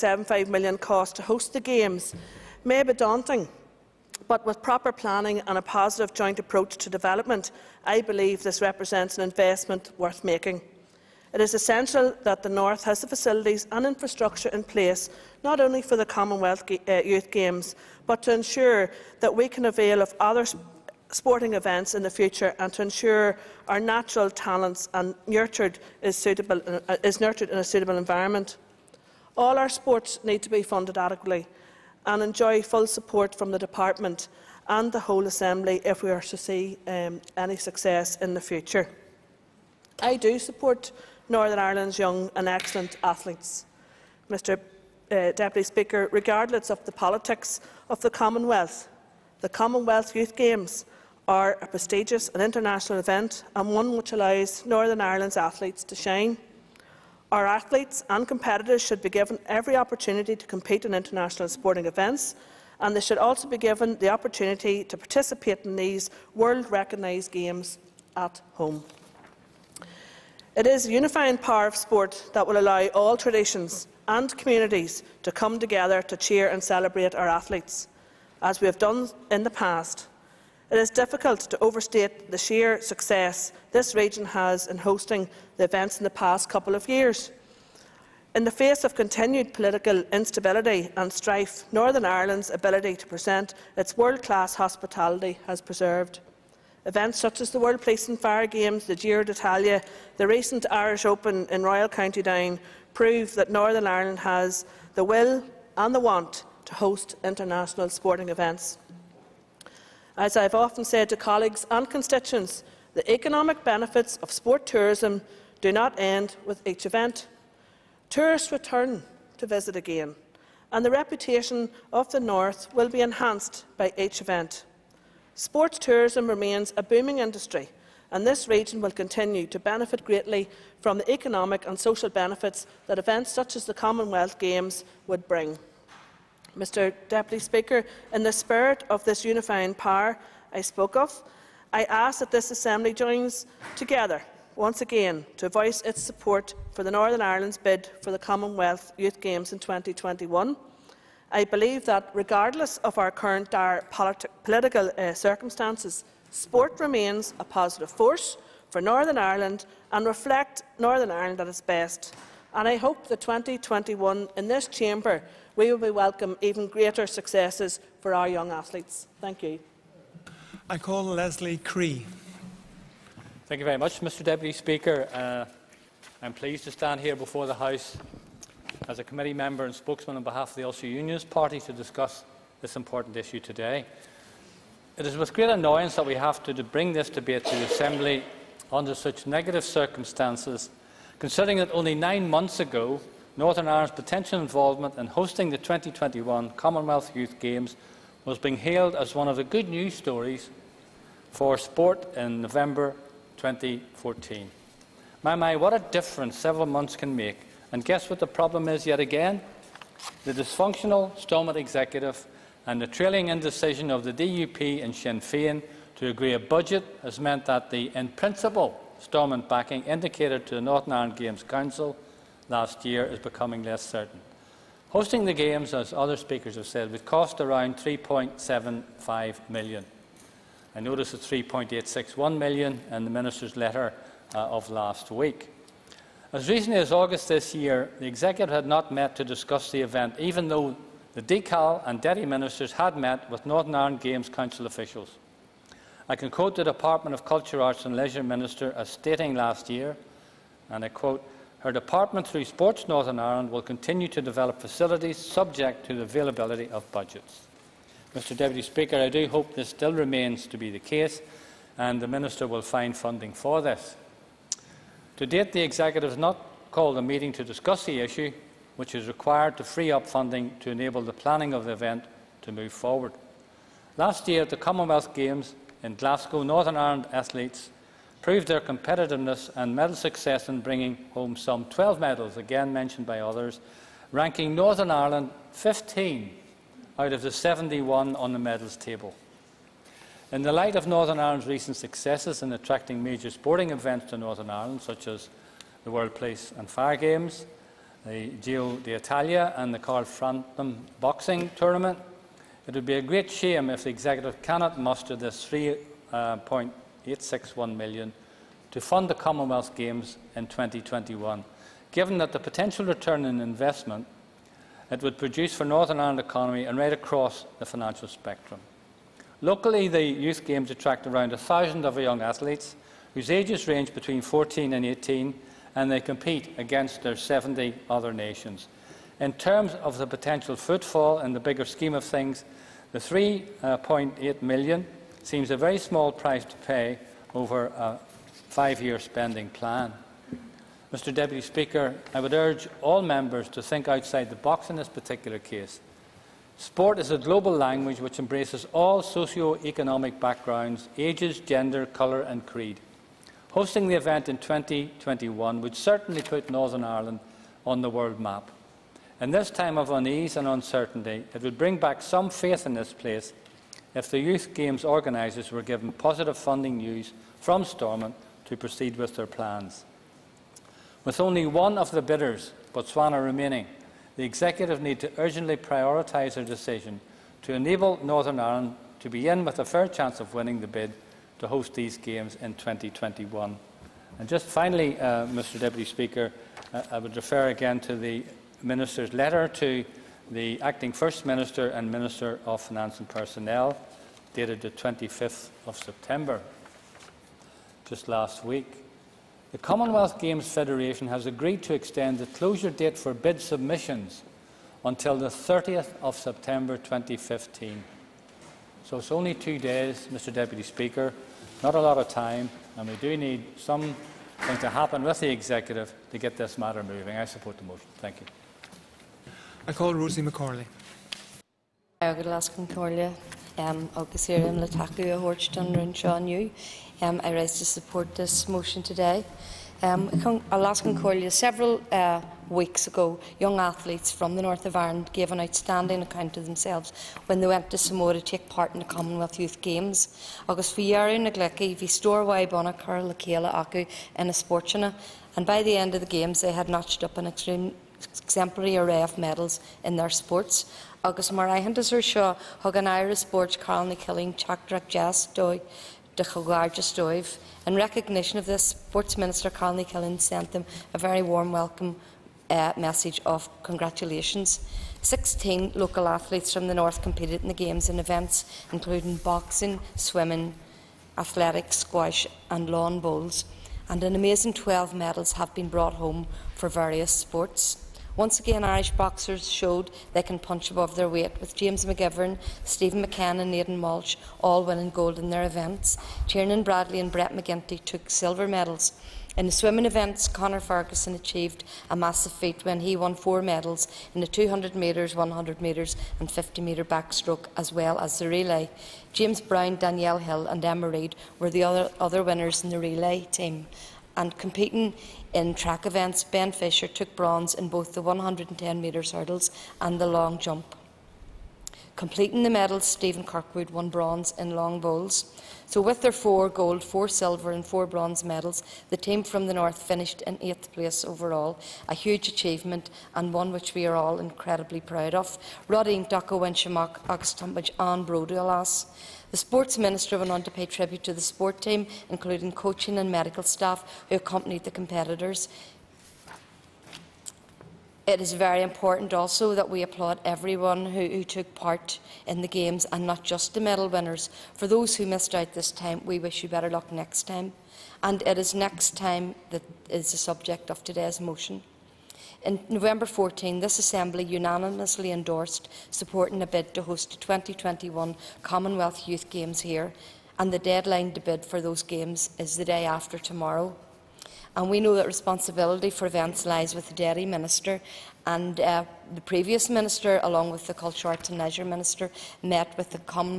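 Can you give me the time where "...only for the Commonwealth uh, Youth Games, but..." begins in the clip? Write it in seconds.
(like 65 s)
15 s.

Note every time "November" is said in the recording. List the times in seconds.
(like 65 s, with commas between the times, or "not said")
202 s, 552 s.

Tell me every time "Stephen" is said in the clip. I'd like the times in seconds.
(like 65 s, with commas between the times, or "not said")
482 s, 512 s.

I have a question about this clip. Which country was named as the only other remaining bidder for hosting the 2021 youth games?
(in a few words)
Botswana.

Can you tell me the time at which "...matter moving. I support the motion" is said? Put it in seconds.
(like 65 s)
416 s.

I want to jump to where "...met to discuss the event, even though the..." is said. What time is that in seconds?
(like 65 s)
238 s.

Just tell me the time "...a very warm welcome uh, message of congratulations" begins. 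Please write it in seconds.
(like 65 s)
460 s.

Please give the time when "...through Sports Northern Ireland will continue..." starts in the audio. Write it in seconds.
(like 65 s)
252 s.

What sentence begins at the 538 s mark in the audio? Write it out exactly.
It is very important also that we applaud everyone who, who took part in the Games and not just the medal winners.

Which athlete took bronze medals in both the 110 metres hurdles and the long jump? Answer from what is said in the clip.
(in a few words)
Ben Fisher.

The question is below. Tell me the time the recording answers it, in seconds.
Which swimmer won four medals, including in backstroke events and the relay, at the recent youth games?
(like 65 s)
490 s.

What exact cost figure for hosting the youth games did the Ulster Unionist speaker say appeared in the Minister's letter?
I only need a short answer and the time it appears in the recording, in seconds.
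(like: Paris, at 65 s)
3.861 million, at 231 s.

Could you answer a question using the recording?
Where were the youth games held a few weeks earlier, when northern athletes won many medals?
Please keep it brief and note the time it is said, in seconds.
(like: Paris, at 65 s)
Samoa, at 437 s.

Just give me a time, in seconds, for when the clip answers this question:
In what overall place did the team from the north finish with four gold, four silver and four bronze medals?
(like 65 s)
520 s.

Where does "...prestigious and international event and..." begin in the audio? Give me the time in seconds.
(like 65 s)
51 s.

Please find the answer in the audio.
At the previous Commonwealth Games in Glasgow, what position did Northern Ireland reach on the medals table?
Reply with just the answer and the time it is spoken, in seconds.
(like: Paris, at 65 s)
15, at 285 s.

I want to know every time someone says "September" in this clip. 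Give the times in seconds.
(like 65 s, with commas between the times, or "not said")
395 s, 406 s.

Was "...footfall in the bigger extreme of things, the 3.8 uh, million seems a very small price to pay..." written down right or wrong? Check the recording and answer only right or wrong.
wrong.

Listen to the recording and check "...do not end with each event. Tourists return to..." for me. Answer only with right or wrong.
right.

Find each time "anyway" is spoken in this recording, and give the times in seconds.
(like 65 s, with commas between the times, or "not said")
not said.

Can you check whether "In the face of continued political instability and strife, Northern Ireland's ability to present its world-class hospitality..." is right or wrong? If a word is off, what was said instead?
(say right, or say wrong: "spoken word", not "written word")
right.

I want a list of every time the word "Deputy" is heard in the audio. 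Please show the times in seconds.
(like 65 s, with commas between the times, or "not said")
45 s, 137 s, 174 s, 241 s, 258 s, 341 s, 385 s, 410 s.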